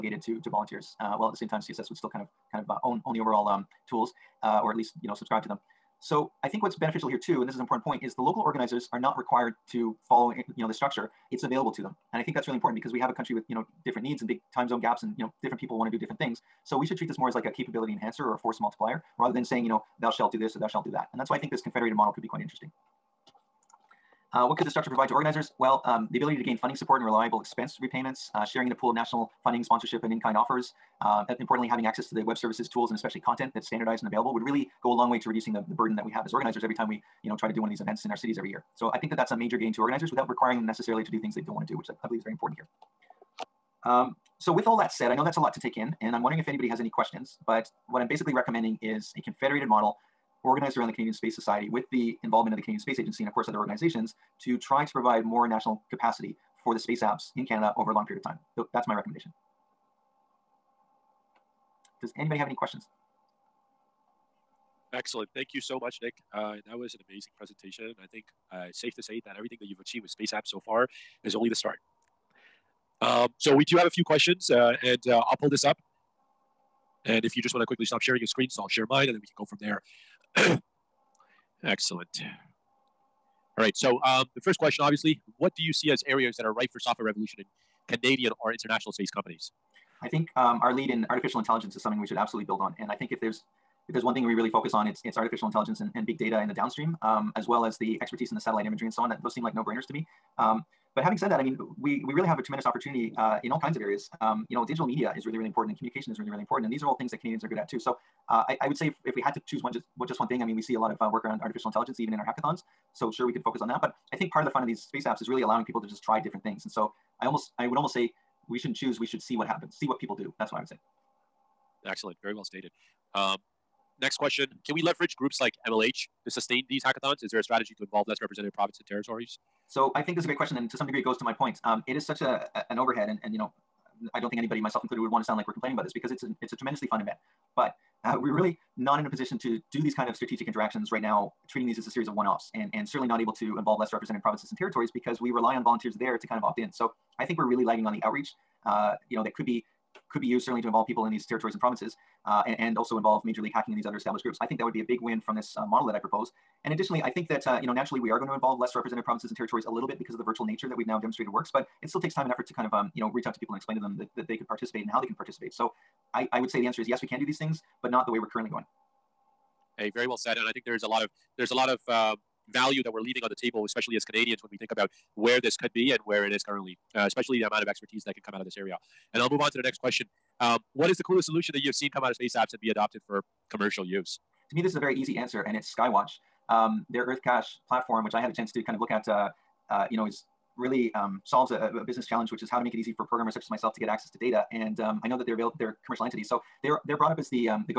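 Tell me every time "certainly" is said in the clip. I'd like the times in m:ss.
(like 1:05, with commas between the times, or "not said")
2:22, 2:30.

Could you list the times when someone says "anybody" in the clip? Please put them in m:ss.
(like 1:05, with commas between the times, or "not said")
0:46, 1:02, 2:14.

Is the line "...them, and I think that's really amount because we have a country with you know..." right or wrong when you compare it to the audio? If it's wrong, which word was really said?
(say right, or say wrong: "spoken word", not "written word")
wrong: "important", not "amount".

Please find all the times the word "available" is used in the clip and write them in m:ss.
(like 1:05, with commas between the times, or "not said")
0:11, 0:34, 3:15.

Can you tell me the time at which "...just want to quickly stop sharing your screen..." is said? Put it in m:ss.
1:17.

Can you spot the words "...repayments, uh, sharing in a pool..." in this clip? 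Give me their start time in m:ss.
0:27.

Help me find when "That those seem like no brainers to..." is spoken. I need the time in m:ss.
1:39.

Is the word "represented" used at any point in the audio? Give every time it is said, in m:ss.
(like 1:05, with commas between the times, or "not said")
2:08, 2:23, 2:38.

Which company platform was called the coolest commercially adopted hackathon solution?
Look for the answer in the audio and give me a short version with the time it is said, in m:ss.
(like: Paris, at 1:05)
EarthCache, at 3:07.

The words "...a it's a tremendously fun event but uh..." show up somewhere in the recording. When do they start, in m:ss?
2:16.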